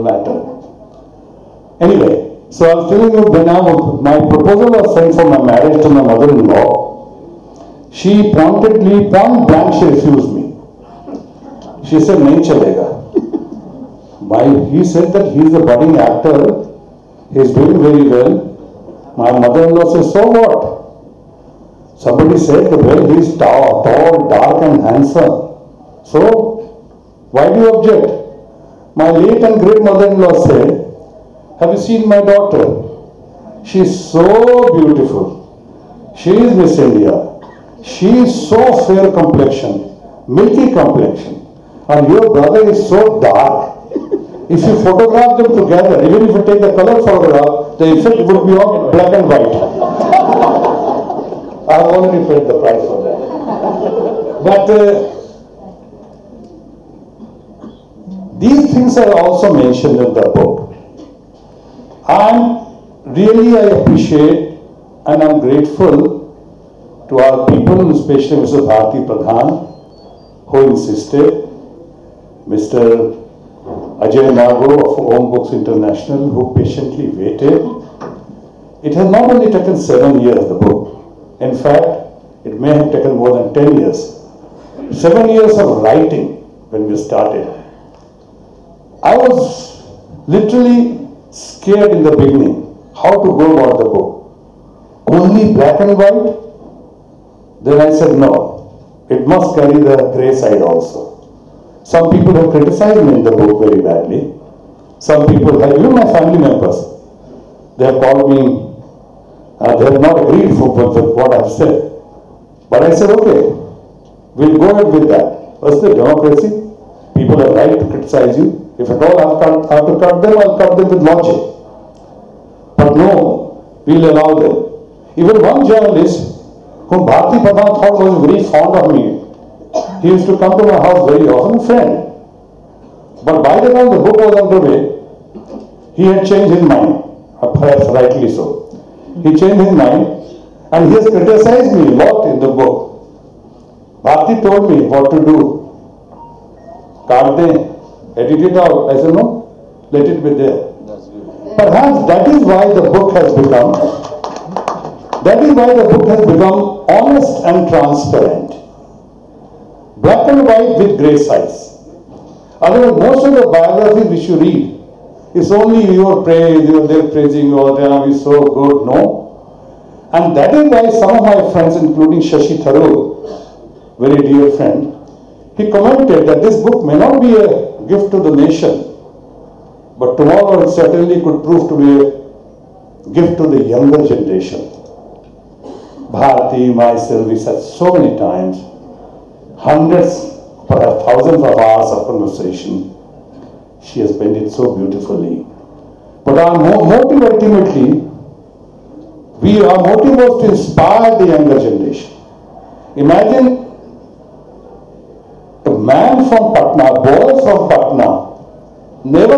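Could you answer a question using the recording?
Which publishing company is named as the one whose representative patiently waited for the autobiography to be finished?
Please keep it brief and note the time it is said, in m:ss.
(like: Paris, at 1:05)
Om Books International, at 1:15.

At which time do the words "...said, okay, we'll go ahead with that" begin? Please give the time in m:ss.
1:52.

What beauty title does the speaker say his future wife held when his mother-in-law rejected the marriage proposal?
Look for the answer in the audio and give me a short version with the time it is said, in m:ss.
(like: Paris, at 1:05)
Miss India, at 0:36.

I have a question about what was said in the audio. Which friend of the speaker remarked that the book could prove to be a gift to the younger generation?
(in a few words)
Shashi Tharoor.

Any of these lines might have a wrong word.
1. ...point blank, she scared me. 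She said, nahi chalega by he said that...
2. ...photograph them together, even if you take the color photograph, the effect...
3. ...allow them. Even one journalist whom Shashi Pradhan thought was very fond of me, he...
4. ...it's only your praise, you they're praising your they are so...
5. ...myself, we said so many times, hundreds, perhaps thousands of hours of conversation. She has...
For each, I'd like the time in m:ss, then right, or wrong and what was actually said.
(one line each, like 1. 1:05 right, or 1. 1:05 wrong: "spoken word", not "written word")
1. 0:09 wrong: "refused", not "scared"
2. 0:44 right
3. 2:04 wrong: "Bharti", not "Shashi"
4. 2:45 right
5. 3:06 right.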